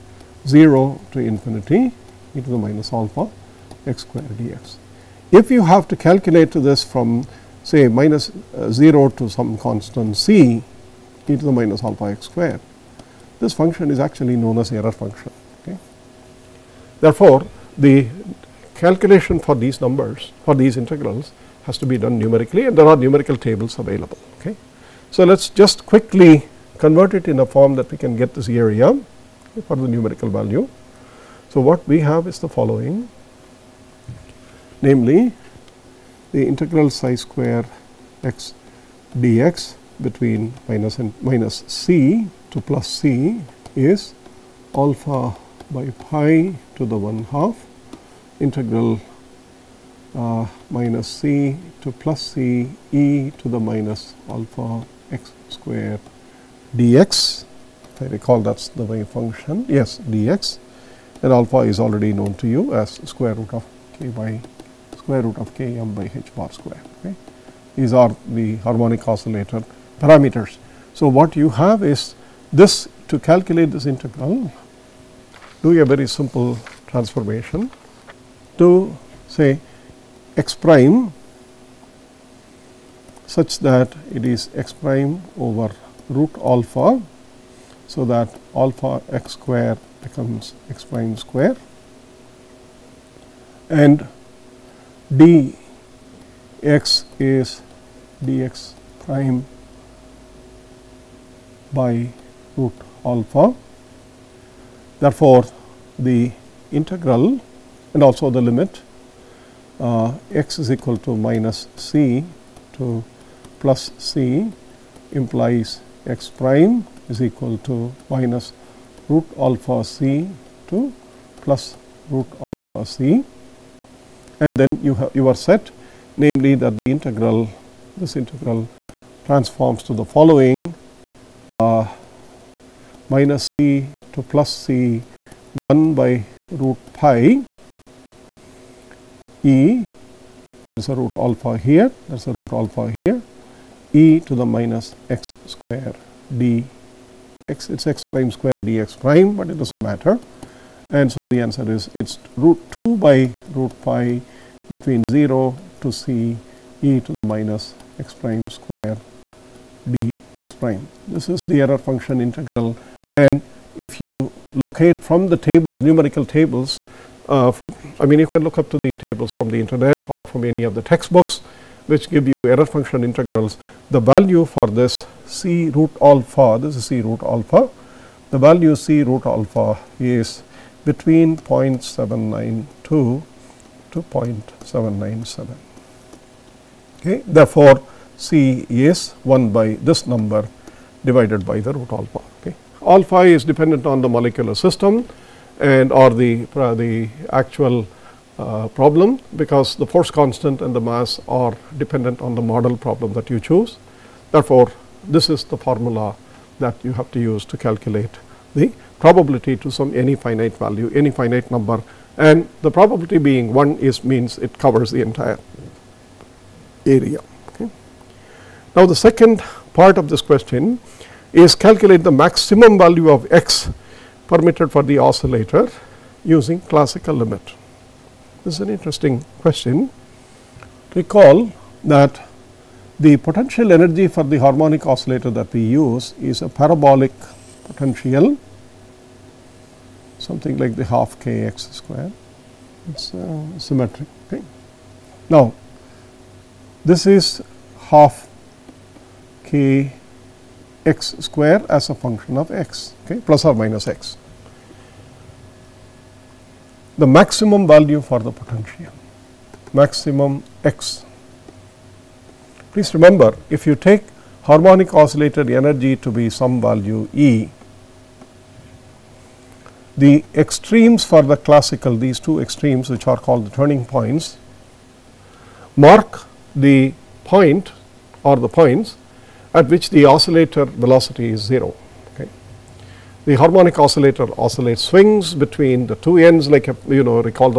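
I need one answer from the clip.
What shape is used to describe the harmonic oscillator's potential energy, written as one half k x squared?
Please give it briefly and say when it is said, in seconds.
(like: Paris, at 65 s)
parabolic, at 236 s.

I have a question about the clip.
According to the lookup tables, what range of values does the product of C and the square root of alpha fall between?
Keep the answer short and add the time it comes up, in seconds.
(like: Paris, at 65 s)
0.792 to 0.797, at 181 s.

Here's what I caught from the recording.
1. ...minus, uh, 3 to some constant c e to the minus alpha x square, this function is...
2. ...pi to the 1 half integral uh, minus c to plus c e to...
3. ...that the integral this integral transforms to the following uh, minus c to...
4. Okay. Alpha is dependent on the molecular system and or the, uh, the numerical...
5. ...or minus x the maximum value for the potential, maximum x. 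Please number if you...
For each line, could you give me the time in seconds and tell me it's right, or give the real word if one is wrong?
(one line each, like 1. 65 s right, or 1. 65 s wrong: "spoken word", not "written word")
1. 7 s wrong: "0", not "3"
2. 46 s right
3. 126 s right
4. 192 s wrong: "actual", not "numerical"
5. 253 s wrong: "remember", not "number".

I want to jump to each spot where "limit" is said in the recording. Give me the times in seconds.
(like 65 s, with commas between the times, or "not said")
108 s, 227 s.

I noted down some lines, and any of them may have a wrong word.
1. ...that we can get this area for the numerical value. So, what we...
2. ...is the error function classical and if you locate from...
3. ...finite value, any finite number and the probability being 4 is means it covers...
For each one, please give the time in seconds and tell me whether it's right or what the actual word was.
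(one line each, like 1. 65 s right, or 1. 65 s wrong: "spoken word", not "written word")
1. 27 s right
2. 161 s wrong: "integral", not "classical"
3. 210 s wrong: "1", not "4".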